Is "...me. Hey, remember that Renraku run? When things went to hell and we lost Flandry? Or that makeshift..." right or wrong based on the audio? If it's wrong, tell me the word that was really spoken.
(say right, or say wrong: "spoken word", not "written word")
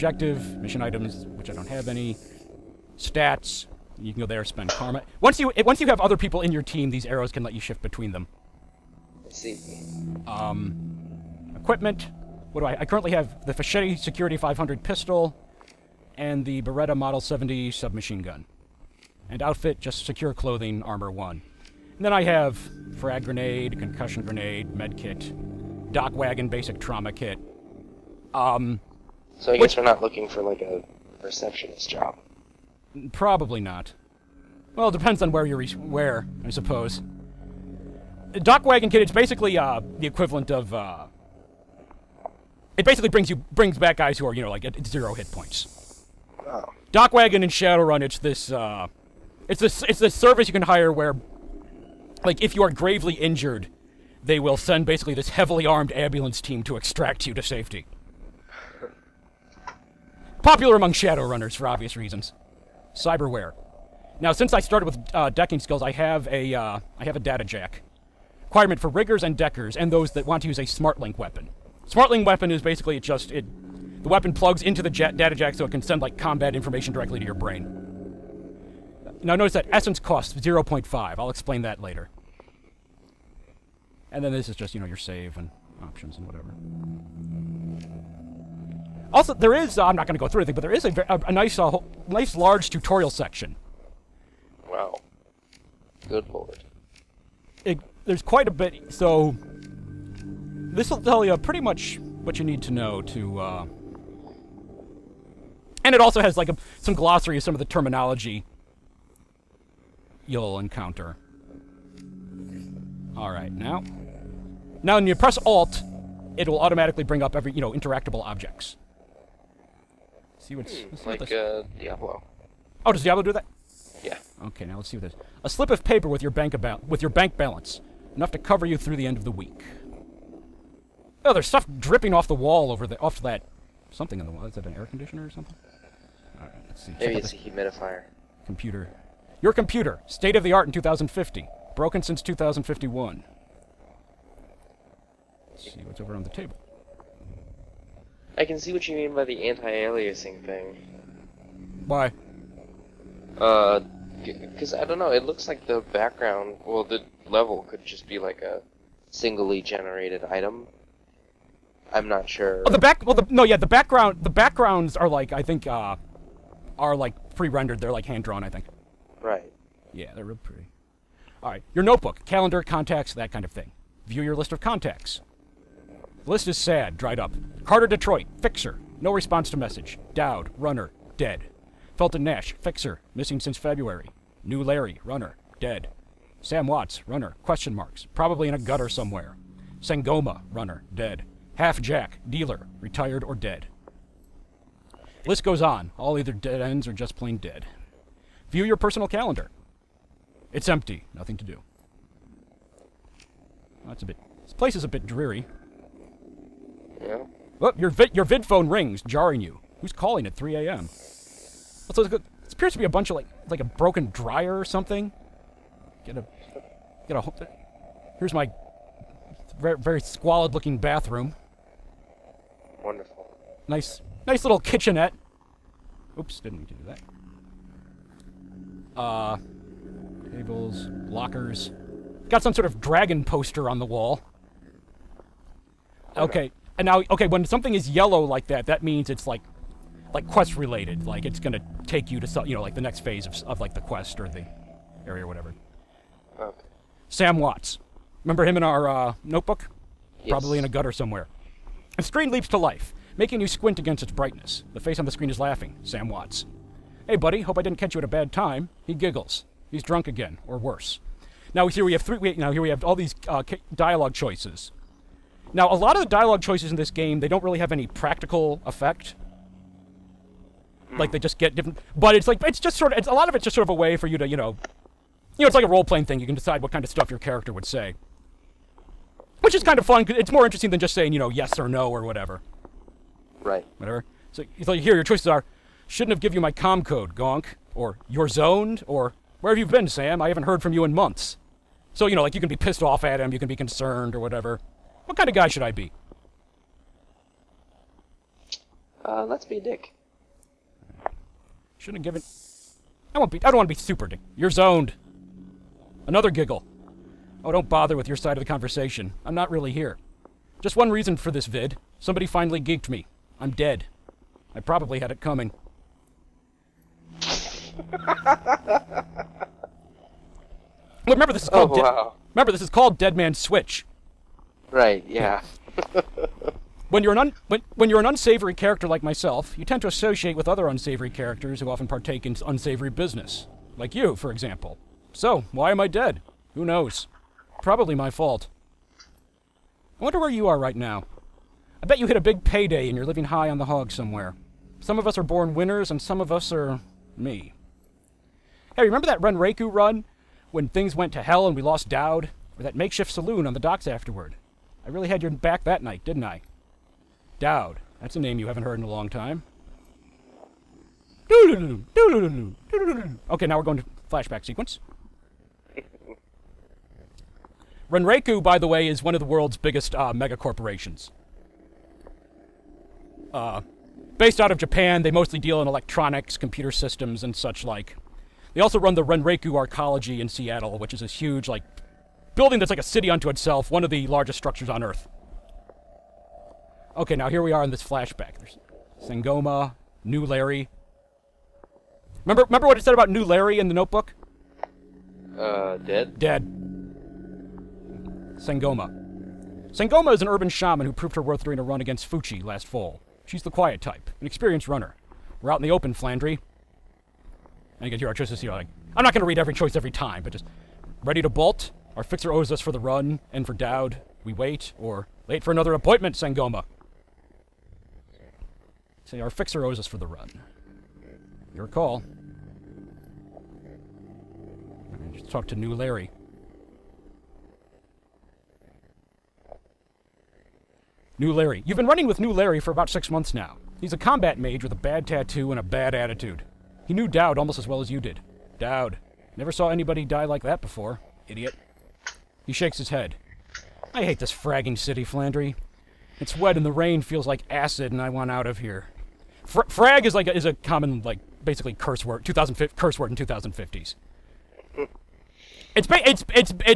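wrong: "Dowd", not "Flandry".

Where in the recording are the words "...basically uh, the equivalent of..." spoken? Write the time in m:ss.
0:39.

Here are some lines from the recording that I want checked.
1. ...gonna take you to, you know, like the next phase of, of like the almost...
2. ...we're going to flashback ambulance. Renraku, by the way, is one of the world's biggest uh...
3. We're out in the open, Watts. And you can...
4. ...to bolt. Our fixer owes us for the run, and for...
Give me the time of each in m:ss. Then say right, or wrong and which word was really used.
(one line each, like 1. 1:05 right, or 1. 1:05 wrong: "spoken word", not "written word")
1. 4:01 wrong: "quest", not "almost"
2. 6:03 wrong: "sequence", not "ambulance"
3. 6:45 wrong: "Flandry", not "Watts"
4. 6:51 right.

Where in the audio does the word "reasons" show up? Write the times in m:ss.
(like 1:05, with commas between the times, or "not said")
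1:01, 5:10.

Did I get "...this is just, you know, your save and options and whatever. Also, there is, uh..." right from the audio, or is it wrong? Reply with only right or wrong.
right.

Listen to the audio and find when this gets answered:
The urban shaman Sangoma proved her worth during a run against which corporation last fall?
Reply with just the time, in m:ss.
6:42.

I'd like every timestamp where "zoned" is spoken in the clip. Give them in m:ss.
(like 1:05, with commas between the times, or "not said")
4:48, 5:04.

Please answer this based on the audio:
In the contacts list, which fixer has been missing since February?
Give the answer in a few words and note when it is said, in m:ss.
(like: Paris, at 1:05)
Felton Nash, at 3:01.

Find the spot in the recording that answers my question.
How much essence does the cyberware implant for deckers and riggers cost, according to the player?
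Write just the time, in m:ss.
1:20.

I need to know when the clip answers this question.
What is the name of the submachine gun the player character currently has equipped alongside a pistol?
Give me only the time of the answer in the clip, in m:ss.
0:16.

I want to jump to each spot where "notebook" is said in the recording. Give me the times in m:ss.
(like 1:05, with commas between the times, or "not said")
2:51, 4:09, 6:33.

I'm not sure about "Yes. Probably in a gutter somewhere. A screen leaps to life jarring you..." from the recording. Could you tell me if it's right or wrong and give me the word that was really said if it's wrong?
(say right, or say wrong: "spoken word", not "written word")
wrong: "making", not "jarring".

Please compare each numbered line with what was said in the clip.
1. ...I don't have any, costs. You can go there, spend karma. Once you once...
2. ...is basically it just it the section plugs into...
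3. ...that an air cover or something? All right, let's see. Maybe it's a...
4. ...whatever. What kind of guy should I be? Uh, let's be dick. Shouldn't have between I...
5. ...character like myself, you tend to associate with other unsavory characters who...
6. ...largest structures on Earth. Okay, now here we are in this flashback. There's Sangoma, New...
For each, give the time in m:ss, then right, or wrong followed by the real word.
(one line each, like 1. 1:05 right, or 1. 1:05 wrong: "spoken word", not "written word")
1. 0:01 wrong: "stats", not "costs"
2. 1:12 wrong: "weapon", not "section"
3. 2:14 wrong: "conditioner", not "cover"
4. 4:54 wrong: "given", not "between"
5. 5:28 right
6. 6:24 right.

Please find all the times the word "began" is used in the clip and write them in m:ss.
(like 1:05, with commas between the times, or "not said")
not said.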